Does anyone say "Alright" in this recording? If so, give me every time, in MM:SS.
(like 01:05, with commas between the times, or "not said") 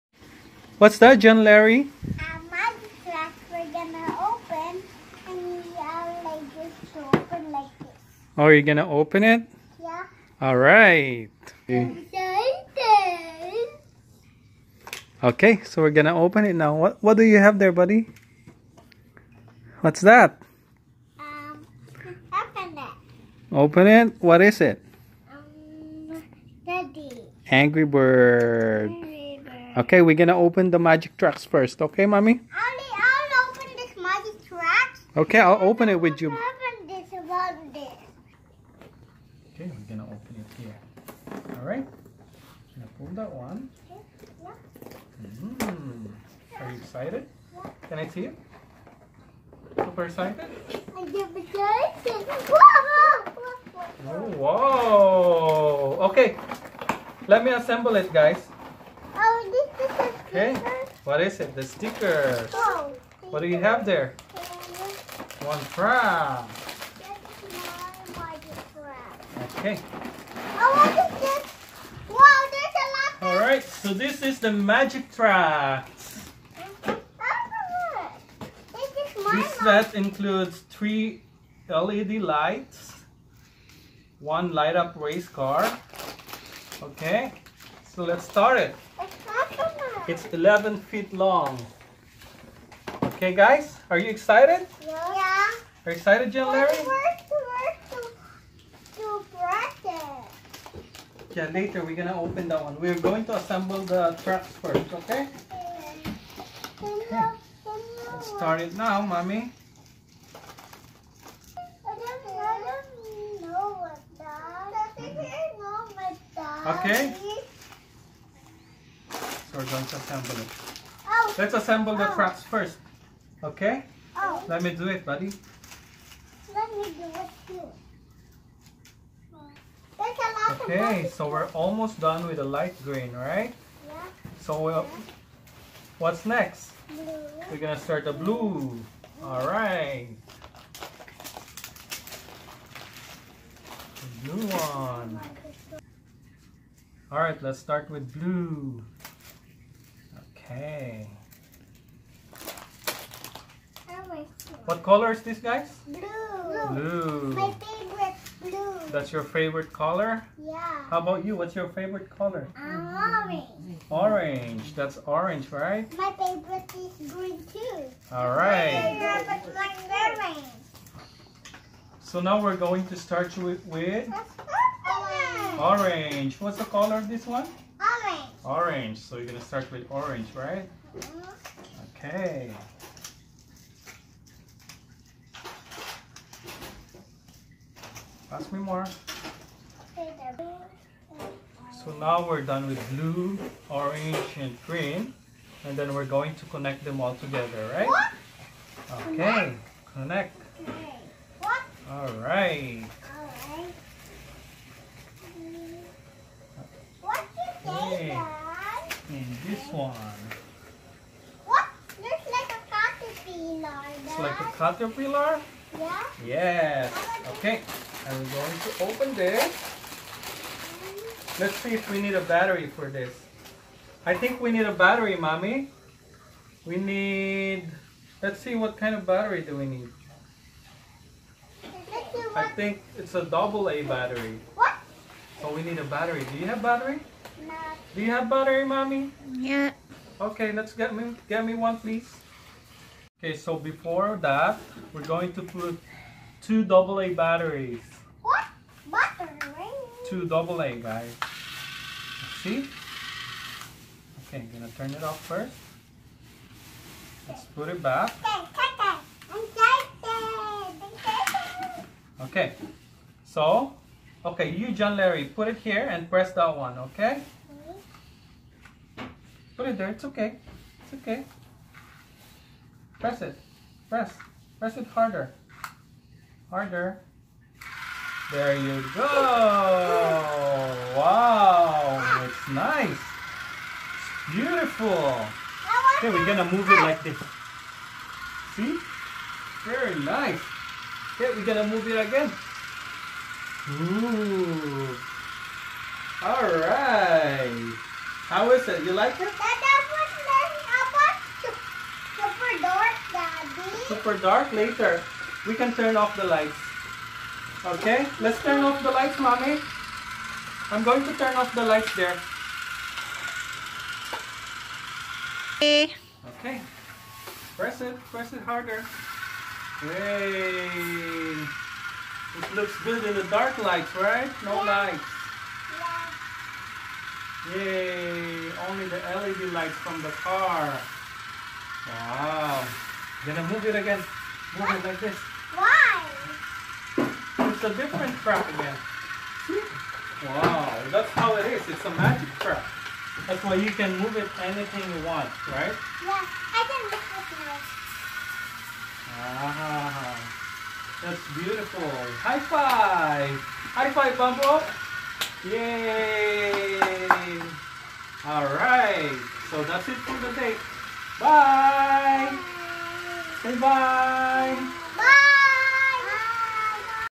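04:56, 05:58.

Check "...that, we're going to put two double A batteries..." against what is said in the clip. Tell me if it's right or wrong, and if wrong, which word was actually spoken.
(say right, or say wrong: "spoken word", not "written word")
right.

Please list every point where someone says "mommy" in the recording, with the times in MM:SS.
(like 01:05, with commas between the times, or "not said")
00:32, 01:49, 03:45, 03:58, 05:09.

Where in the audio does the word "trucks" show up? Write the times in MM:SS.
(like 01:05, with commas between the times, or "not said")
01:44.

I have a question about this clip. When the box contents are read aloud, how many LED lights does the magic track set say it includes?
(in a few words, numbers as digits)
3.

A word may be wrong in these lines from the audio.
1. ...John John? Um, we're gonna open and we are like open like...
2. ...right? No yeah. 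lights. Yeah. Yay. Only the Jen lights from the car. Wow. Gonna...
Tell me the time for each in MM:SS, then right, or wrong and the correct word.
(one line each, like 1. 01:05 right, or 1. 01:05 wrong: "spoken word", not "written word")
1. 00:01 wrong: "Larry", not "John"
2. 05:23 wrong: "LED", not "Jen".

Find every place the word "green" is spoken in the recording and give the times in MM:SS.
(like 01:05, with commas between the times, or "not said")
02:12, 02:47, 03:14.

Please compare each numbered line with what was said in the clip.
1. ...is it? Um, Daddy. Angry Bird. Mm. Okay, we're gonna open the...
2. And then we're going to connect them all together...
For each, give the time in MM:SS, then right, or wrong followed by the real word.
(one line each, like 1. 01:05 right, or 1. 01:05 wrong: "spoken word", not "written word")
1. 00:24 right
2. 03:15 right.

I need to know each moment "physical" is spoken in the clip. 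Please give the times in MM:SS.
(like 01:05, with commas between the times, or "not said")
not said.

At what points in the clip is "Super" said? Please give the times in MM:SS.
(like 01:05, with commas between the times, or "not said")
00:49, 05:03.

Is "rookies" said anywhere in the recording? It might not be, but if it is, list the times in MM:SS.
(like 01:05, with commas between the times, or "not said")
not said.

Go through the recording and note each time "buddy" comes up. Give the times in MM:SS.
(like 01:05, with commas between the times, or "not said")
00:17, 02:05.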